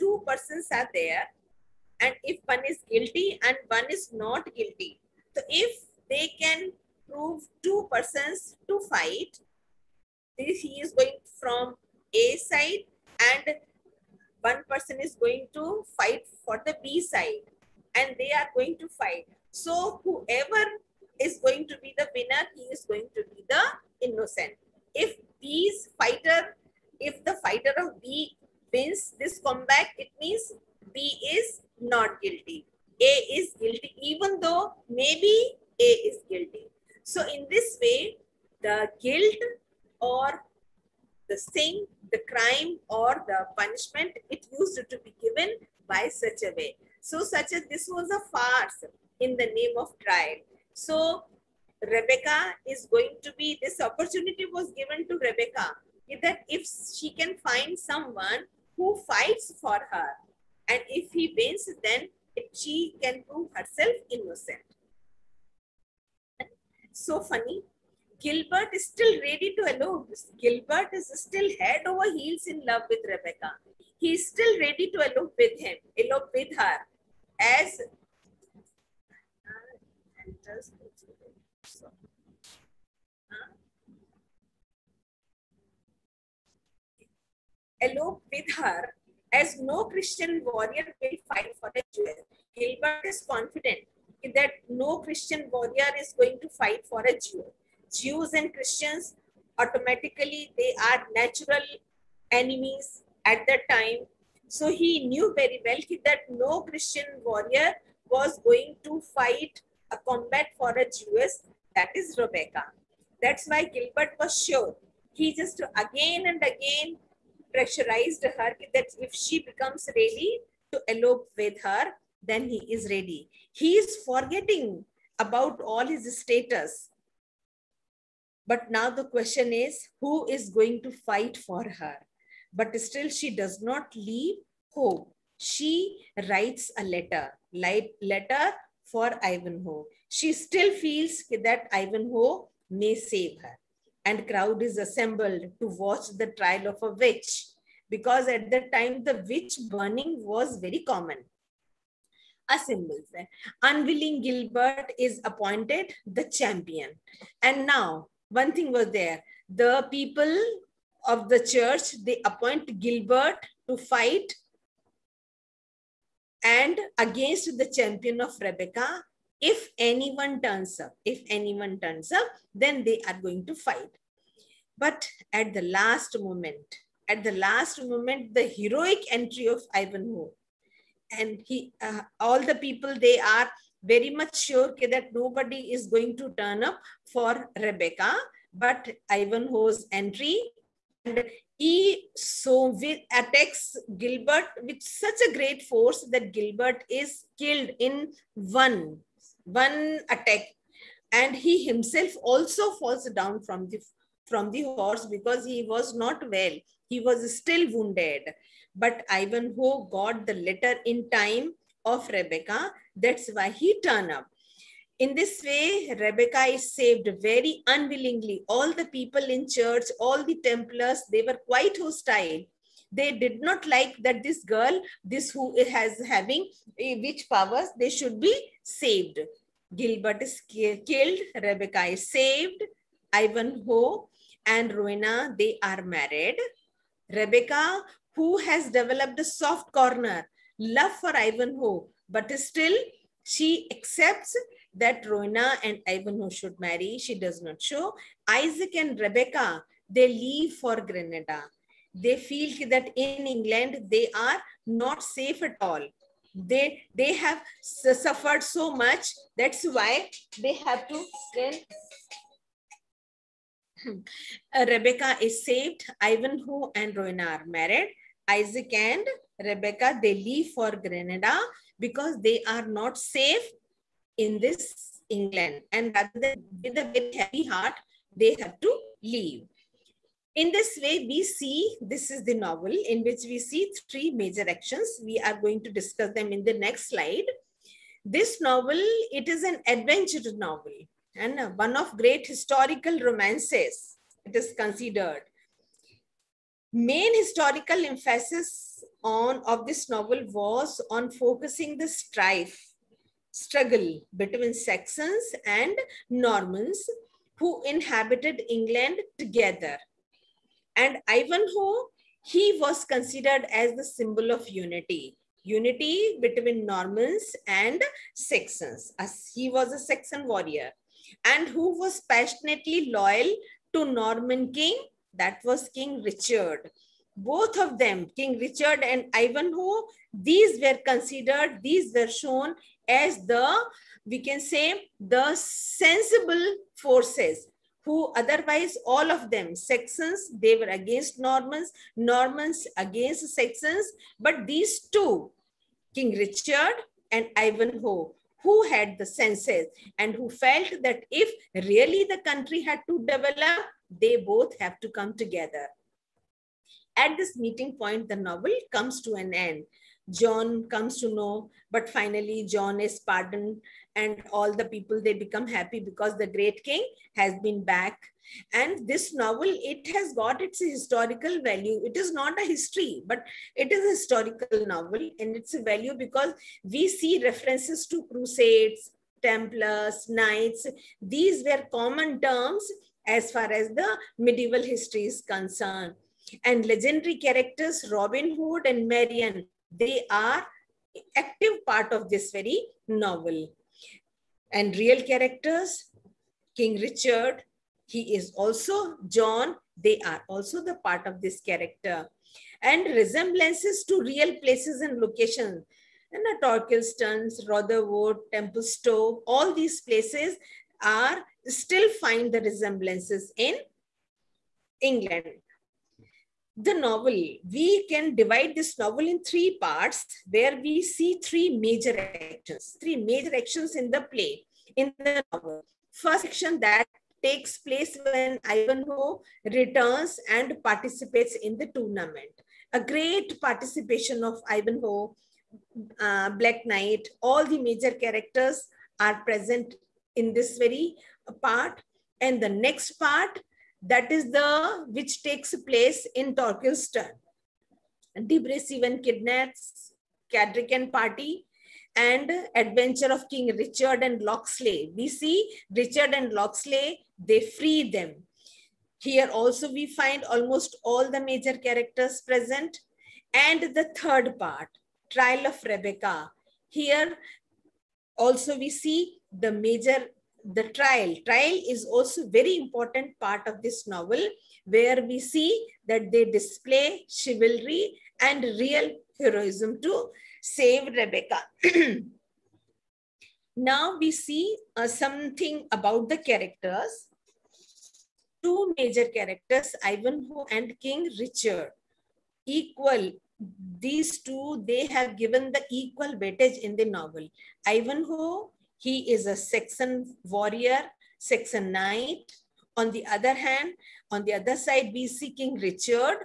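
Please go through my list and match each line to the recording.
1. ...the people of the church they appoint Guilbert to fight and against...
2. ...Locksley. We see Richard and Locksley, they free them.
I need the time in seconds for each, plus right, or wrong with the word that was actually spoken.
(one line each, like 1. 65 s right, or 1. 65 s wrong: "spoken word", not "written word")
1. 159 s right
2. 454 s right.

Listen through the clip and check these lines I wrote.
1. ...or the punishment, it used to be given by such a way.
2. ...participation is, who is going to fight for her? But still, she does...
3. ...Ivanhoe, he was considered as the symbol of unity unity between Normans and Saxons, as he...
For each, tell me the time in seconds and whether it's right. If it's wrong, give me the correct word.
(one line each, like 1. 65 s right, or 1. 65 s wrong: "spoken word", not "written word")
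1. 42 s right
2. 129 s wrong: "question", not "participation"
3. 311 s right.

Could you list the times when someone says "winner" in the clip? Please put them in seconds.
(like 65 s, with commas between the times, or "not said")
22 s.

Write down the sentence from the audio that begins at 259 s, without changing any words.
That's why they have to then.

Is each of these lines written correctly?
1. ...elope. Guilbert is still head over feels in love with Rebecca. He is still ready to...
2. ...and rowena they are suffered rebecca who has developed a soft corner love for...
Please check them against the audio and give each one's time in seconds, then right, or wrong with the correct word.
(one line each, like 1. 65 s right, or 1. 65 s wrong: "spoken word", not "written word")
1. 69 s wrong: "heels", not "feels"
2. 234 s wrong: "married", not "suffered".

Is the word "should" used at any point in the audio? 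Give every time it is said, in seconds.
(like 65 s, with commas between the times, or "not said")
227 s, 246 s.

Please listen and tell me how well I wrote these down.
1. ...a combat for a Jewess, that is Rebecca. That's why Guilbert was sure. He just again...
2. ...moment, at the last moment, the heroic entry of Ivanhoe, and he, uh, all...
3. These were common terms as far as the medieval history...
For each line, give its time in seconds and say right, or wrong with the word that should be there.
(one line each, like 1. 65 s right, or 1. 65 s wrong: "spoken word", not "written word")
1. 109 s right
2. 176 s right
3. 381 s right.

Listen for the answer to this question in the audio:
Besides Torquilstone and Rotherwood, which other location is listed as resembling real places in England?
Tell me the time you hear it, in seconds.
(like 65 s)
408 s.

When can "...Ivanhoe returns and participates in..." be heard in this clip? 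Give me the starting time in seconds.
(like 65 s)
428 s.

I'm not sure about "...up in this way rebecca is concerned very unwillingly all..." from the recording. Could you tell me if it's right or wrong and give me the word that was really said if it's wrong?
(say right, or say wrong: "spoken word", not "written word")
wrong: "saved", not "concerned".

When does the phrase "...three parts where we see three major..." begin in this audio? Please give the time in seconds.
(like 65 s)
419 s.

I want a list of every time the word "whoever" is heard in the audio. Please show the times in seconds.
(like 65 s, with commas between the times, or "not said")
20 s.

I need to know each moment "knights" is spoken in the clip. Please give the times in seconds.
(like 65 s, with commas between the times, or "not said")
380 s, 436 s, 501 s.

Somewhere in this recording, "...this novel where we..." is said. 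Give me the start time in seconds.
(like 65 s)
473 s.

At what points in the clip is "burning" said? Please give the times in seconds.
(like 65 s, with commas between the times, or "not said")
149 s.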